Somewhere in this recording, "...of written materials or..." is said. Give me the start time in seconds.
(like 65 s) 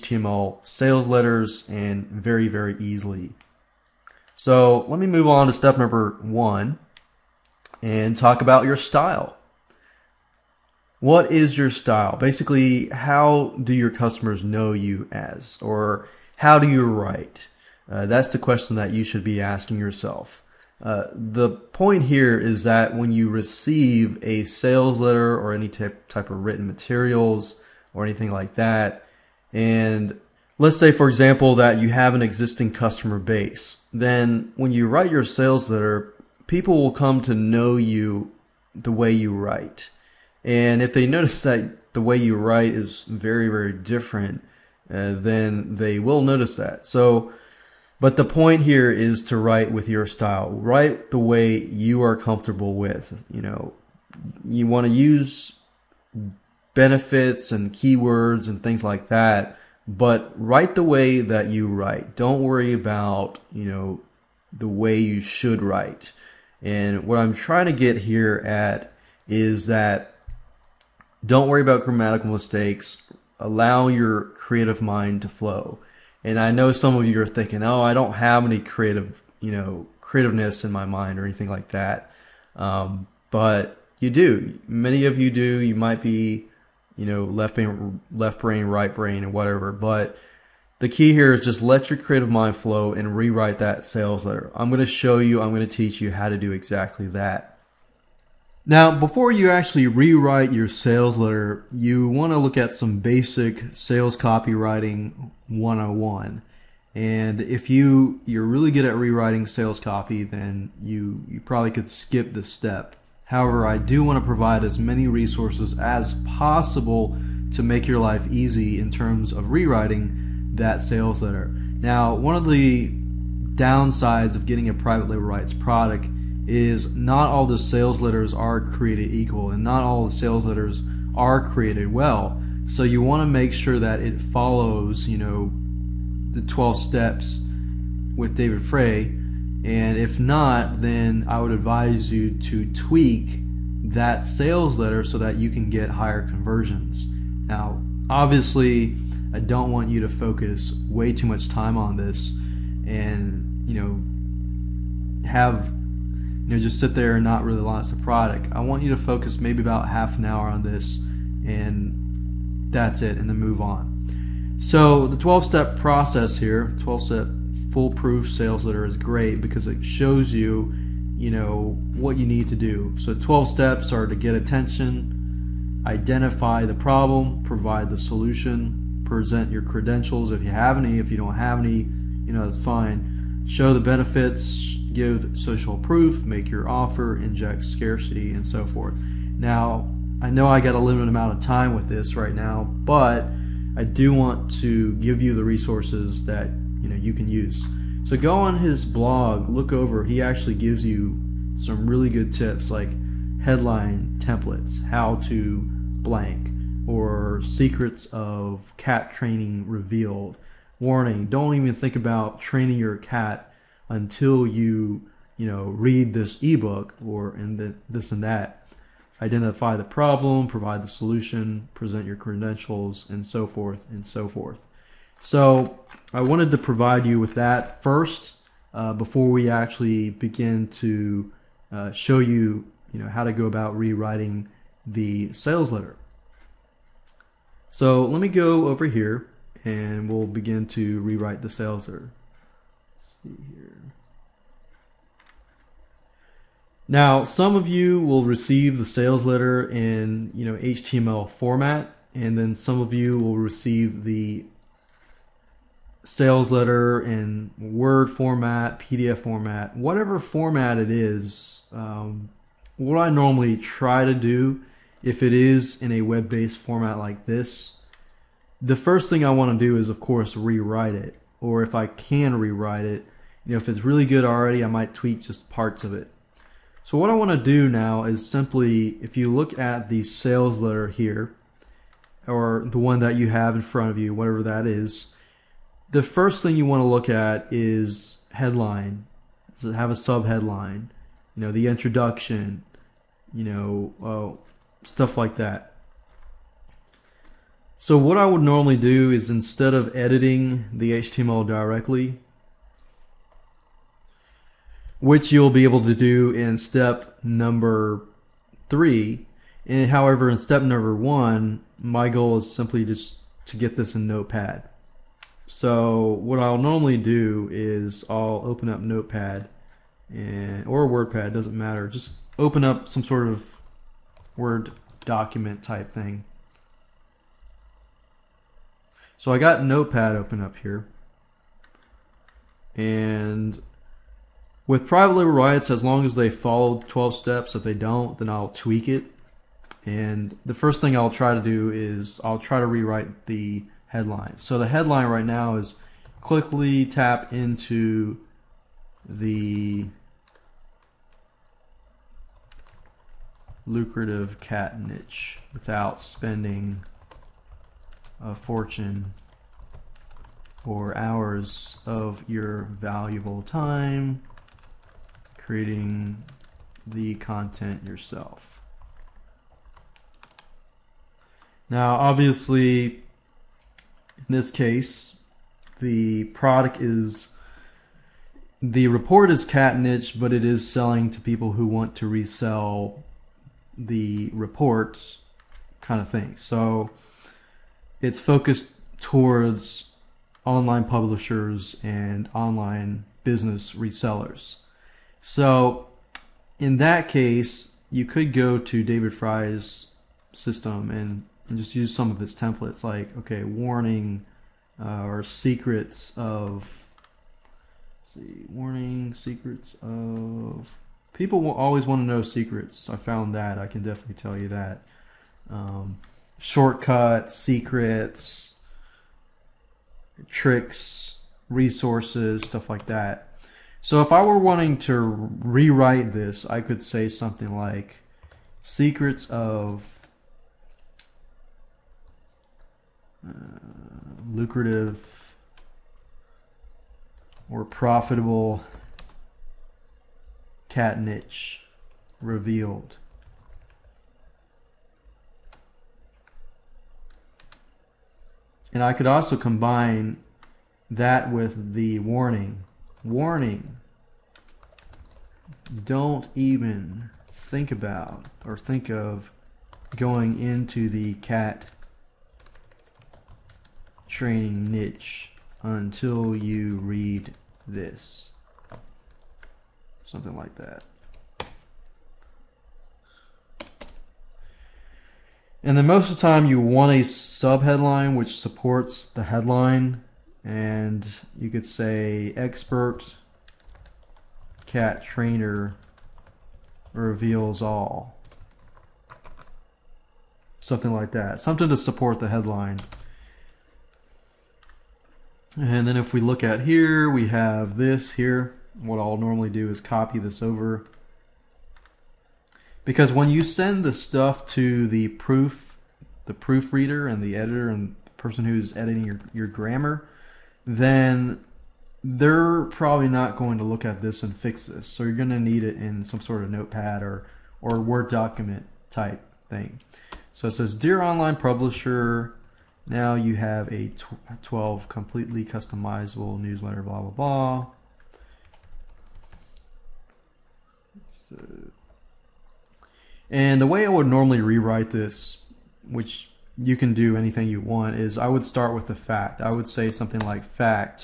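26 s.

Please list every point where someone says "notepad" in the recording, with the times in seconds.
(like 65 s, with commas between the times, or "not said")
314 s, 318 s, 329 s, 516 s.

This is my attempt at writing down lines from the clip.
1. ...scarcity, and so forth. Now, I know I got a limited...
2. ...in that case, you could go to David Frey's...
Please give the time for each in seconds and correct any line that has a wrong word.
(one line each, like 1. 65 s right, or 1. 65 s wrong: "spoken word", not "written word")
1. 187 s right
2. 396 s right.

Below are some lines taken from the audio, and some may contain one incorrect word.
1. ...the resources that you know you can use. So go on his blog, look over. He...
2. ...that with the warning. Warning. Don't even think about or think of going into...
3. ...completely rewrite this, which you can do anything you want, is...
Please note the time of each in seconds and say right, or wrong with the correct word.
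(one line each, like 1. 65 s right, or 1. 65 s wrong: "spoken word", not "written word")
1. 195 s right
2. 450 s right
3. 534 s wrong: "normally", not "completely".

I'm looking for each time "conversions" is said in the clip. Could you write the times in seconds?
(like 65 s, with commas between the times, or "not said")
146 s.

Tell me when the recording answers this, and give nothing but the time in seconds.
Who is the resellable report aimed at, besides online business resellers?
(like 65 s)
390 s.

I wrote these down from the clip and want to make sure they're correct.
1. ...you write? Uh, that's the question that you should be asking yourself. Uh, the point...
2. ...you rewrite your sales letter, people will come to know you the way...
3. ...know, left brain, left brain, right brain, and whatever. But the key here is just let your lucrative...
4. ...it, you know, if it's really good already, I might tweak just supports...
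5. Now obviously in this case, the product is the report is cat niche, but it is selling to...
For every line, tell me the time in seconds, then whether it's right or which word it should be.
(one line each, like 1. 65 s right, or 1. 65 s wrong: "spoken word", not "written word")
1. 16 s right
2. 34 s wrong: "write", not "rewrite"
3. 87 s wrong: "creative", not "lucrative"
4. 272 s wrong: "parts", not "supports"
5. 371 s right.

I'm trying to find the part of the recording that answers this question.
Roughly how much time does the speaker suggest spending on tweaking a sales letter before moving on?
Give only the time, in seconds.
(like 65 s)
159 s.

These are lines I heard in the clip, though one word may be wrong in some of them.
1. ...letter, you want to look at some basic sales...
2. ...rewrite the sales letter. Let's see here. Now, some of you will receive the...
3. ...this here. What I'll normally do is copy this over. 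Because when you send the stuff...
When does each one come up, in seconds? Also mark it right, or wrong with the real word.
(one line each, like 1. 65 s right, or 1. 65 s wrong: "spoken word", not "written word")
1. 101 s right
2. 241 s right
3. 497 s right.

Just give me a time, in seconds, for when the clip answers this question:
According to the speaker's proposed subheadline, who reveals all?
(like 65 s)
482 s.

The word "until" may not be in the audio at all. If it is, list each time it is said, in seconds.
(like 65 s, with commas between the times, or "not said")
213 s, 465 s.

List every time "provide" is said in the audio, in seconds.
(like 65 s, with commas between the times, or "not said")
114 s, 177 s, 220 s, 226 s.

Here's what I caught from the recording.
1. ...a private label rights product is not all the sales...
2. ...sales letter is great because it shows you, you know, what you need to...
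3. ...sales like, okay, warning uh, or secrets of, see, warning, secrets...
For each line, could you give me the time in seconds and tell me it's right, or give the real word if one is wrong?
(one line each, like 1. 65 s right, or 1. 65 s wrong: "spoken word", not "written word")
1. 124 s right
2. 168 s right
3. 402 s wrong: "templates", not "sales".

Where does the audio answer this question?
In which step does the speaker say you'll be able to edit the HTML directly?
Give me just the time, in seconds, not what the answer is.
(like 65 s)
306 s.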